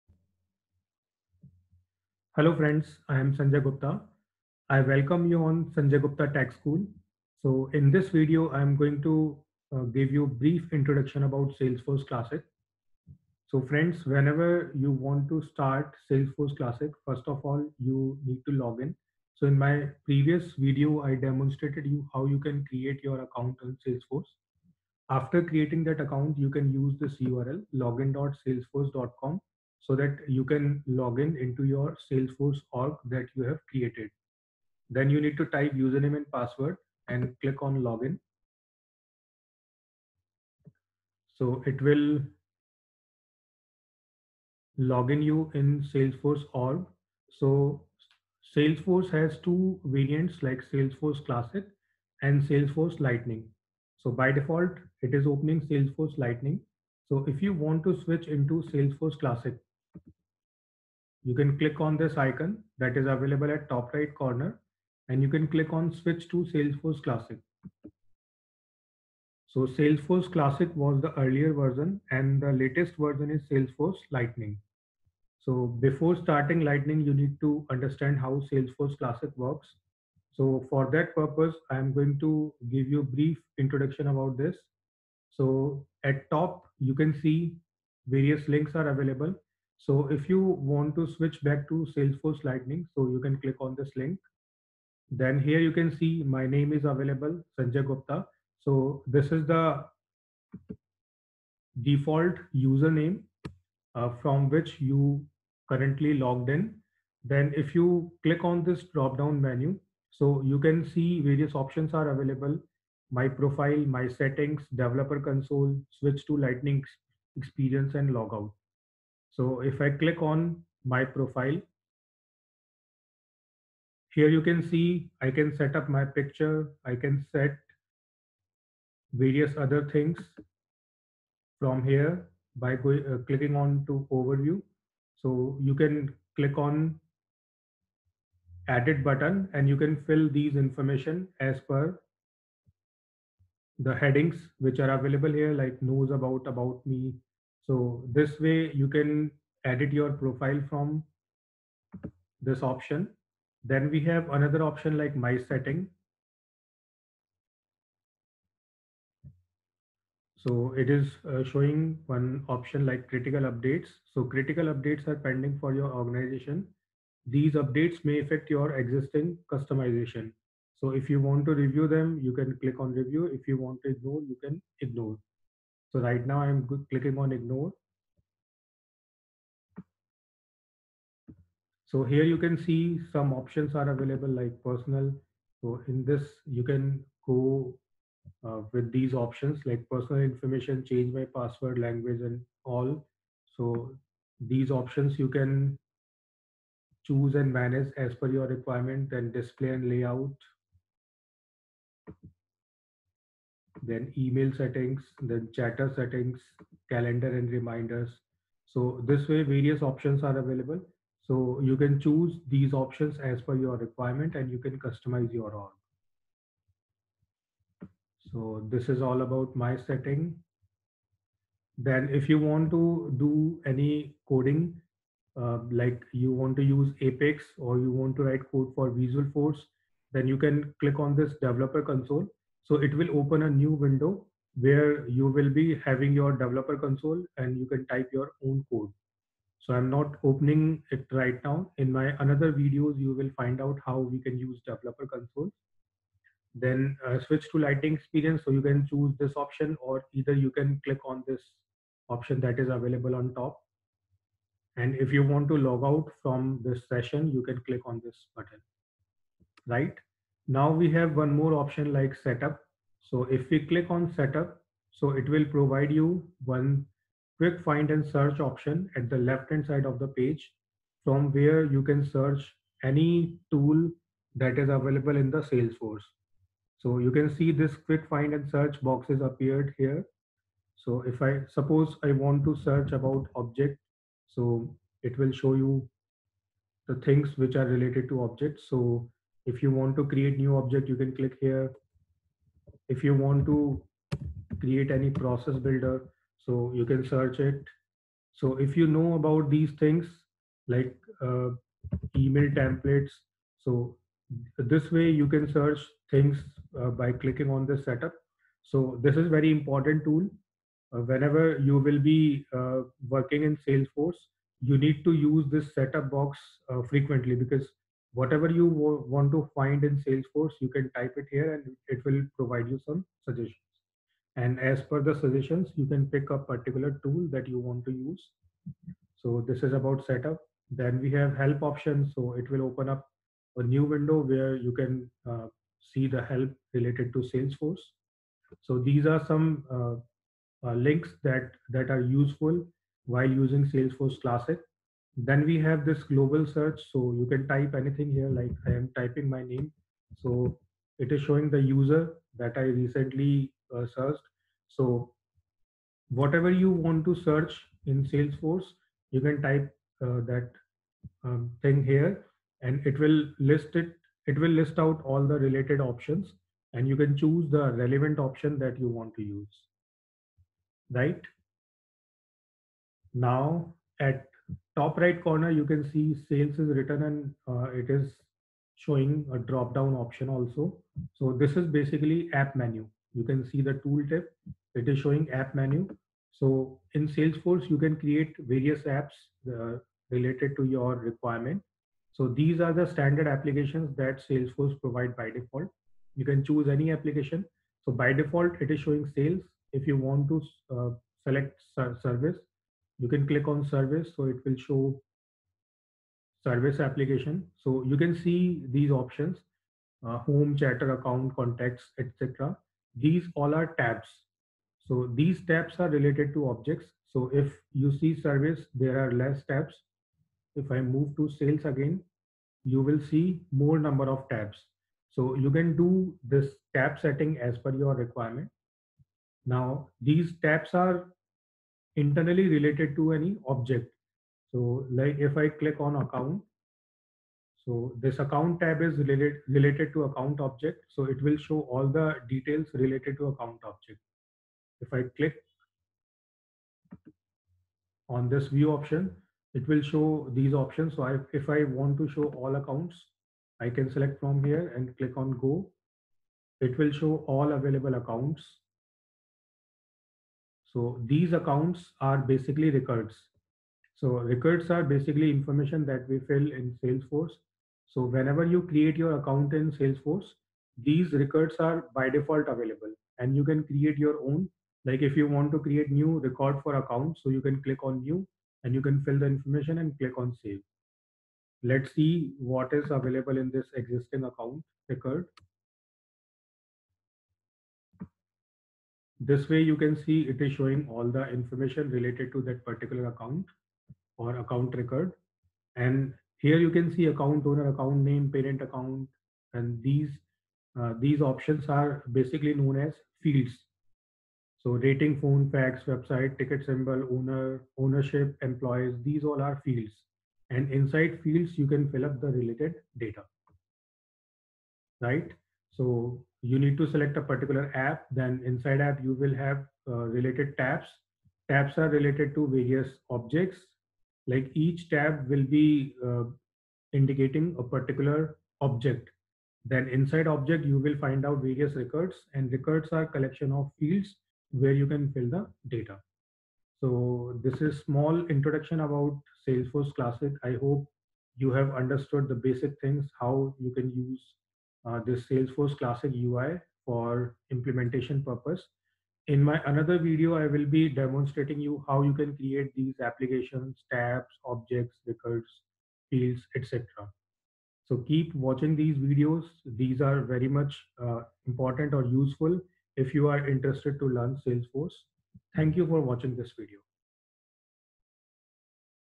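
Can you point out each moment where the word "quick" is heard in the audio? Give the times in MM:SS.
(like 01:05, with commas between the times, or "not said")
04:27, 04:37.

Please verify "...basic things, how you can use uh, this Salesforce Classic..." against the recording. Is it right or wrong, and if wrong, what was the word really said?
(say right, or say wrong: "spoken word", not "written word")
right.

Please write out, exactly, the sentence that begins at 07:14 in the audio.
So like if I click on account, so this account tab is related, related to account object.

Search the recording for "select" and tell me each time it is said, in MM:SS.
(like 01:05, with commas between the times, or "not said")
06:41, 07:33, 08:36.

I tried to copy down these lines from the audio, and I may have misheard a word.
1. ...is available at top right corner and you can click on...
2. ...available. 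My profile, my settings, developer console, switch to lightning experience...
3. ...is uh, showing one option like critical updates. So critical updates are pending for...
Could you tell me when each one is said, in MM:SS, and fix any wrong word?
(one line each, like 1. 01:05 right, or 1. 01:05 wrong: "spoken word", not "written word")
1. 01:02 right
2. 01:52 right
3. 02:40 right.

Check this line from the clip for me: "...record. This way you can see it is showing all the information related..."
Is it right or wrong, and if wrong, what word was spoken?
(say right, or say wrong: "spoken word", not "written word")
right.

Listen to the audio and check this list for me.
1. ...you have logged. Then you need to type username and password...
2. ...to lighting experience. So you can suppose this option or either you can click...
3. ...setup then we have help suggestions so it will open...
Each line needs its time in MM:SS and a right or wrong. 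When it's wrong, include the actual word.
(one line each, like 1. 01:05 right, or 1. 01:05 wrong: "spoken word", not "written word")
1. 00:33 wrong: "created", not "logged"
2. 04:07 wrong: "choose", not "suppose"
3. 05:30 wrong: "options", not "suggestions".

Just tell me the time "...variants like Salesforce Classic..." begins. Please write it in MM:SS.
00:49.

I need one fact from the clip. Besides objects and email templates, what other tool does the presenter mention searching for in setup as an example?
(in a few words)
Process builder.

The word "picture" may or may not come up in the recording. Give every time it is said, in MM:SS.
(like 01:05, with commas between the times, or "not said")
02:06.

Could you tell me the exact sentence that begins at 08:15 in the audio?
And here you can see account owner, account name, parent account, and these uh, these options are basically known as fields.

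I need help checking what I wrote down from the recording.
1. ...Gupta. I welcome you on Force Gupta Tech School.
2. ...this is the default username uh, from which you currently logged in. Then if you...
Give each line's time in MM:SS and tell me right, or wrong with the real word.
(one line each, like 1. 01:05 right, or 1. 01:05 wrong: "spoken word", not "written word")
1. 00:03 wrong: "Sanjay", not "Force"
2. 01:39 right.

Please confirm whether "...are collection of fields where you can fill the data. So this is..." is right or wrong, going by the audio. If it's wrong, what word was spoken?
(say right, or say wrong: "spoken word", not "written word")
right.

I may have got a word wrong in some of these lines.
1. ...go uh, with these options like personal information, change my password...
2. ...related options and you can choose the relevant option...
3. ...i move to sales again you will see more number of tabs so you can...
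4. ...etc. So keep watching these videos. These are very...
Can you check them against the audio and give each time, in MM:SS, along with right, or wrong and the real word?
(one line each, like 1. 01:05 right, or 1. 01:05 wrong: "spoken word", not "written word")
1. 03:07 right
2. 06:05 right
3. 07:00 right
4. 09:16 right.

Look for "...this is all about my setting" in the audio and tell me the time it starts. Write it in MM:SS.
03:38.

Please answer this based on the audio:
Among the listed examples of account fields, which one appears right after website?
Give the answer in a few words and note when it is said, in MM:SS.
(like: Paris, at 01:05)
Ticker symbol, at 08:26.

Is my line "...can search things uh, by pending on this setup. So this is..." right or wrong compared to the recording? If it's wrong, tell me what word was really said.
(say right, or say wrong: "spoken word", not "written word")
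wrong: "clicking", not "pending".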